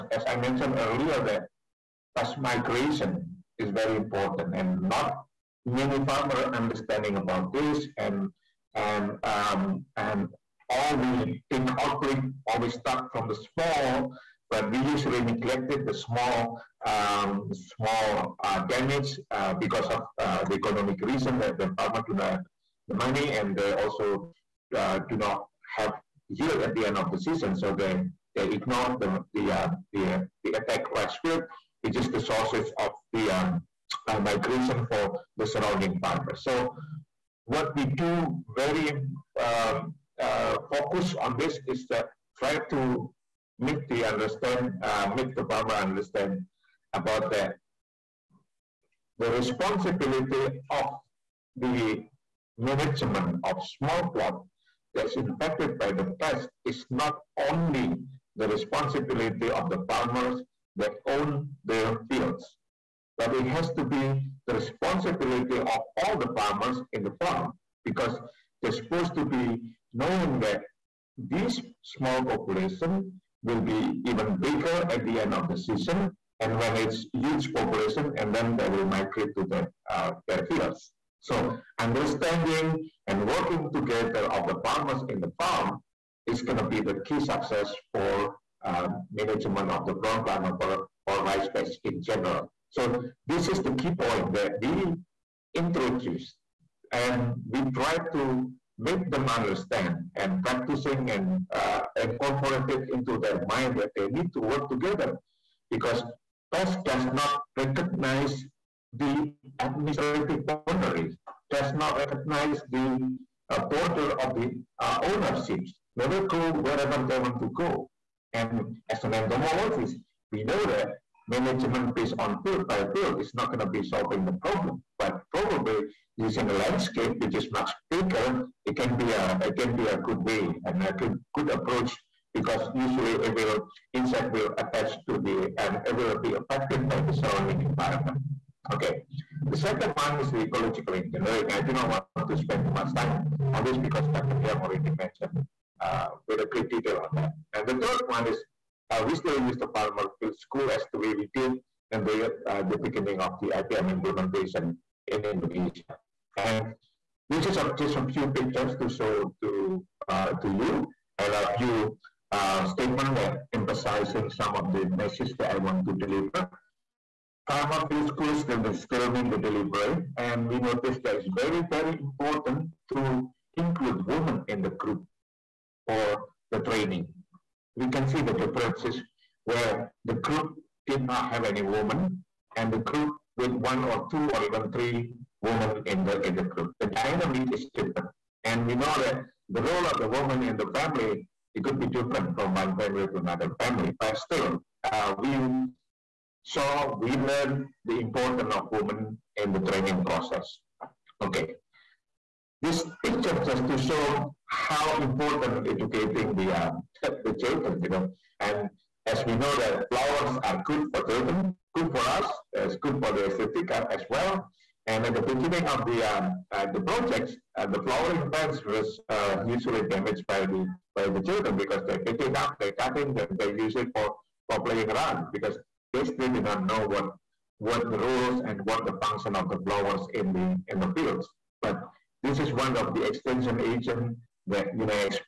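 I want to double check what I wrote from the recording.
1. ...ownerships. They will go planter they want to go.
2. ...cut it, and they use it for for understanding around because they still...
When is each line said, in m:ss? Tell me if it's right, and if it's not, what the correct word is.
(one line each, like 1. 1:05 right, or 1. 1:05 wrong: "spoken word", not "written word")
1. 1:54 wrong: "wherever", not "planter"
2. 3:42 wrong: "playing", not "understanding".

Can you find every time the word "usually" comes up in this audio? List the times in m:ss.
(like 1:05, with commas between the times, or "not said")
0:14, 2:12, 3:39.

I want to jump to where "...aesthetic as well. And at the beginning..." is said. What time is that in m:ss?
3:33.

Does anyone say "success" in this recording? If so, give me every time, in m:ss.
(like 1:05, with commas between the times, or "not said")
1:27.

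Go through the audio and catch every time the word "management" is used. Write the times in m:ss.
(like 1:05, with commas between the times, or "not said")
0:52, 1:29, 2:01.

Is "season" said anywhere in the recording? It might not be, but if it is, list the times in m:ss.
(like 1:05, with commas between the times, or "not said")
0:27, 1:15.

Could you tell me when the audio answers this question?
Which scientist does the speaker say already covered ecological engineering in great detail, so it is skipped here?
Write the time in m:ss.
2:24.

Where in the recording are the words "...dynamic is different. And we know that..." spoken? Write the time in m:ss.
3:06.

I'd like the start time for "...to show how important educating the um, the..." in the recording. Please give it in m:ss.
3:23.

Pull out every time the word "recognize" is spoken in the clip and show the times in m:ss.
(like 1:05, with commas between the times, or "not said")
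1:47, 1:51.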